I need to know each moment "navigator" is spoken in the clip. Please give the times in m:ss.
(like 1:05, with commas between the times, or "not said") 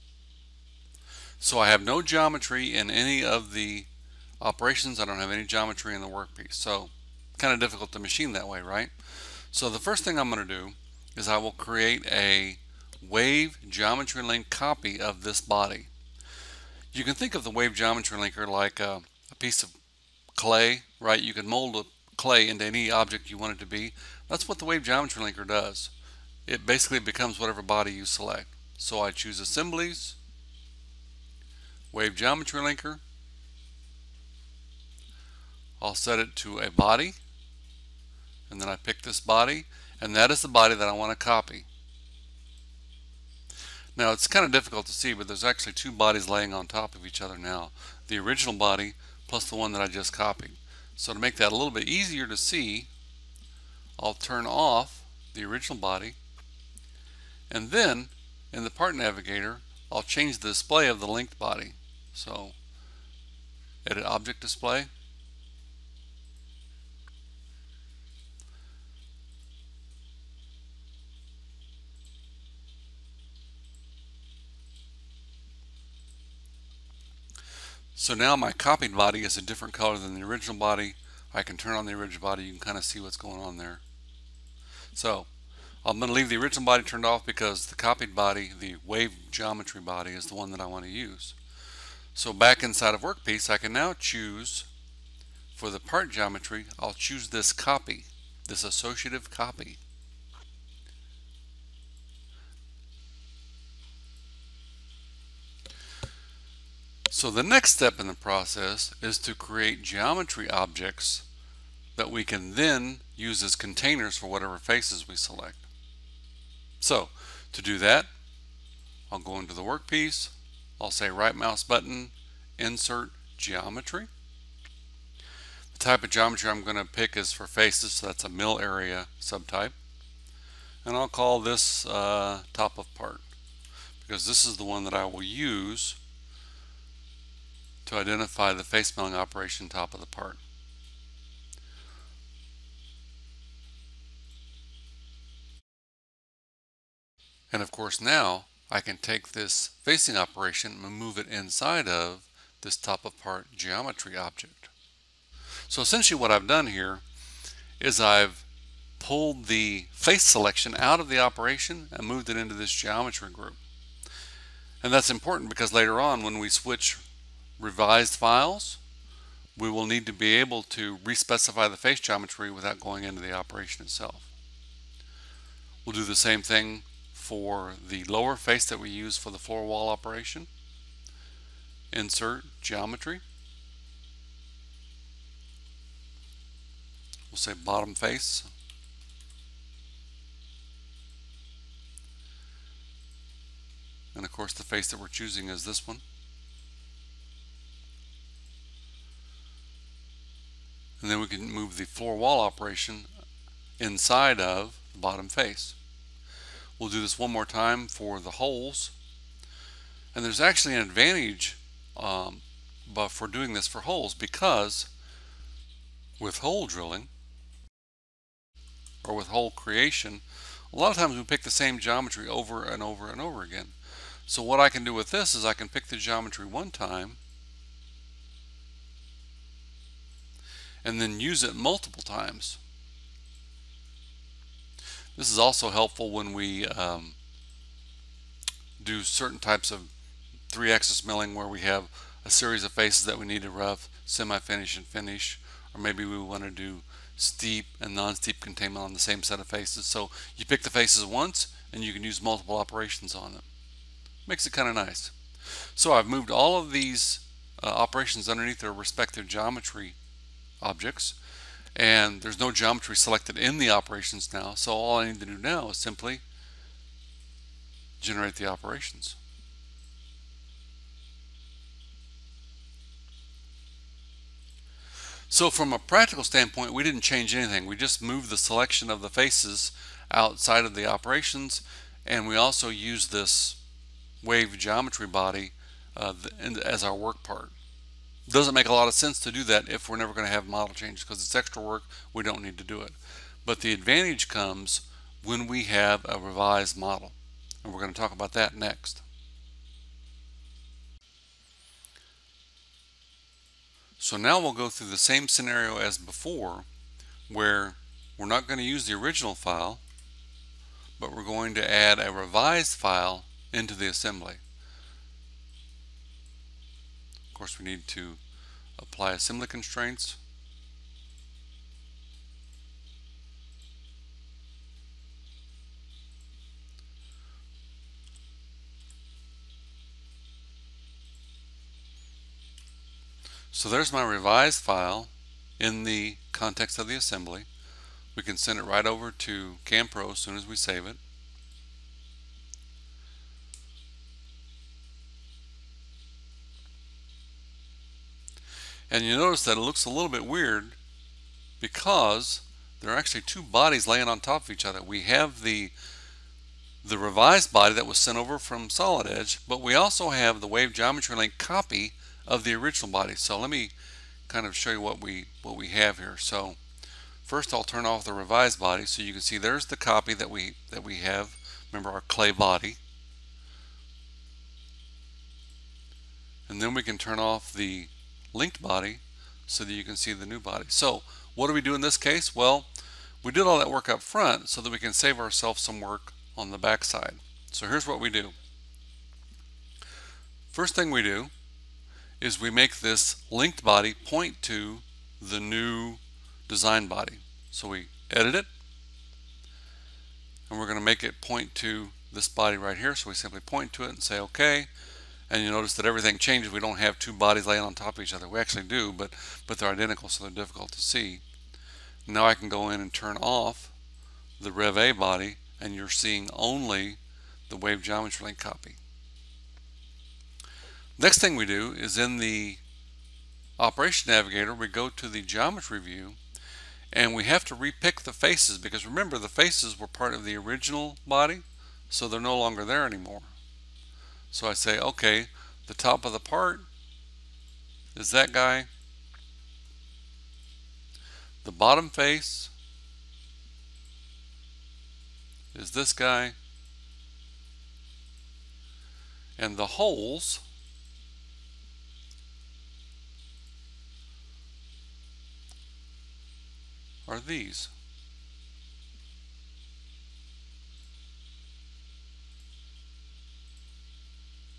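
0:58, 7:04.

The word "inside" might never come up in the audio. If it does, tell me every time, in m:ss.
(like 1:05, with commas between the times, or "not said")
1:32, 2:31, 3:23.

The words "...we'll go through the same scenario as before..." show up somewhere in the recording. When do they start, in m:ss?
5:04.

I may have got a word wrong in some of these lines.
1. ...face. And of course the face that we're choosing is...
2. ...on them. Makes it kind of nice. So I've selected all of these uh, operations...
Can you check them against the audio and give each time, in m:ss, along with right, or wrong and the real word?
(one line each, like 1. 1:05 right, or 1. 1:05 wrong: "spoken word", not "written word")
1. 3:07 right
2. 4:13 wrong: "moved", not "selected".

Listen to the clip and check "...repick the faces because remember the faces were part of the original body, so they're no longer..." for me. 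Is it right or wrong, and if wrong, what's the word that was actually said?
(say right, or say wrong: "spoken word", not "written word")
right.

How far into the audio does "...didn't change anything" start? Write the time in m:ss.
4:36.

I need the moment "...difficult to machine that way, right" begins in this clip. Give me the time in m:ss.
0:07.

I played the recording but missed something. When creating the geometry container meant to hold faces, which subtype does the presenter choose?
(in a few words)
mill area.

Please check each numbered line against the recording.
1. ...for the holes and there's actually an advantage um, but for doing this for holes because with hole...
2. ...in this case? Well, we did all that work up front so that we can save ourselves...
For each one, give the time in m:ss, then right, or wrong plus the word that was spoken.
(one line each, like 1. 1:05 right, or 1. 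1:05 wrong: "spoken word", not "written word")
1. 3:27 right
2. 6:21 right.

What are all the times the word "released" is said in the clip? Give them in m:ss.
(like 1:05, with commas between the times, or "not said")
not said.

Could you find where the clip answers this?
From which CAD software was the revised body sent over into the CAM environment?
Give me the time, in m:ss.
5:58.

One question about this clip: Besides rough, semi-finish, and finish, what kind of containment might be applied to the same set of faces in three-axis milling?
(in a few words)
steep and non-steep.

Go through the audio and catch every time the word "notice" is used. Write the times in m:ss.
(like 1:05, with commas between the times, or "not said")
5:49, 6:45.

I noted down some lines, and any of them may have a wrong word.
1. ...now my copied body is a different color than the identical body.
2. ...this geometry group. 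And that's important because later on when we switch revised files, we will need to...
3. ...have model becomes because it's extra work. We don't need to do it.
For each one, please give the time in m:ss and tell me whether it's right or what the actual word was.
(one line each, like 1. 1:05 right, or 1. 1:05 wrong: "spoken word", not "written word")
1. 1:18 wrong: "original", not "identical"
2. 2:42 right
3. 4:50 wrong: "changes", not "becomes".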